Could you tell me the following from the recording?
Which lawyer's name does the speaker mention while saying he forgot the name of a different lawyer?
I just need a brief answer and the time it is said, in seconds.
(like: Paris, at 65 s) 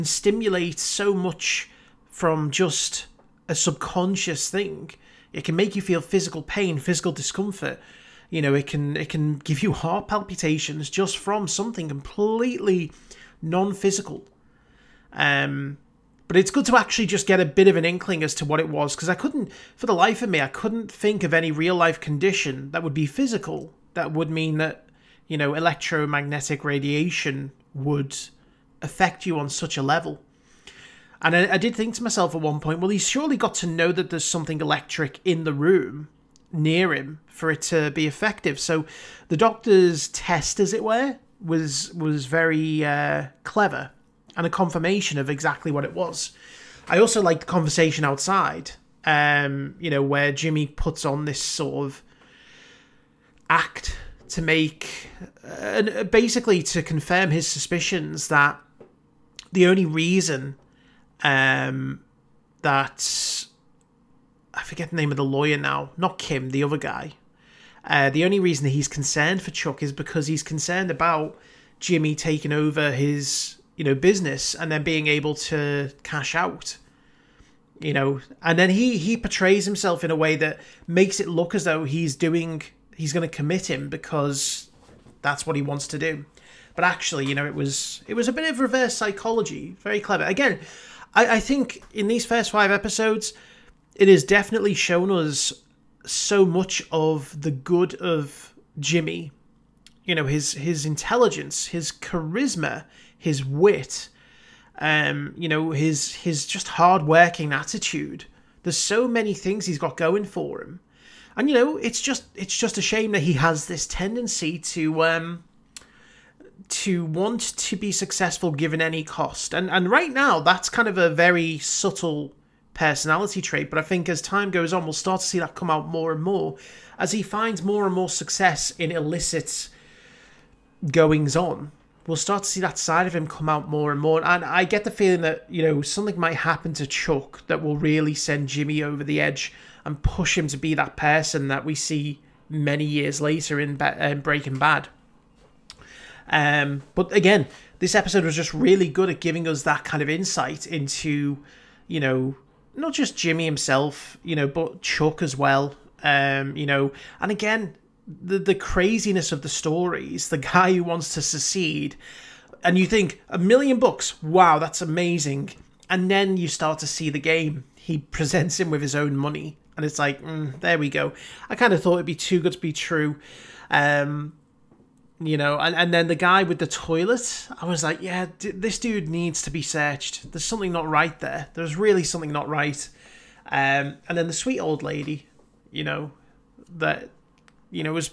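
Kim, at 66 s.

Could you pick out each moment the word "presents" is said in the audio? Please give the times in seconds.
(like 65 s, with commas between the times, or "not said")
167 s.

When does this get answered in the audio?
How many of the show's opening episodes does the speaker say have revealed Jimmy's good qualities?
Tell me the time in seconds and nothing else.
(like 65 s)
92 s.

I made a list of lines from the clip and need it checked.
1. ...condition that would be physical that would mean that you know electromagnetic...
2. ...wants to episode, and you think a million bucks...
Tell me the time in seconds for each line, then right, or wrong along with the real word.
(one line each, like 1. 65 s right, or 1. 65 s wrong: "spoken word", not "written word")
1. 22 s right
2. 160 s wrong: "secede", not "episode".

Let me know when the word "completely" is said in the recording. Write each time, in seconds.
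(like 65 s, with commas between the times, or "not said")
11 s.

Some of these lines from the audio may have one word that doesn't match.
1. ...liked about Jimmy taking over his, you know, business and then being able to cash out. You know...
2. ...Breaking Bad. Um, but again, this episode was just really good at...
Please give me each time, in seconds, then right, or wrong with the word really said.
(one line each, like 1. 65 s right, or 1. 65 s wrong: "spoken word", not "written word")
1. 70 s wrong: "concerned", not "liked"
2. 144 s right.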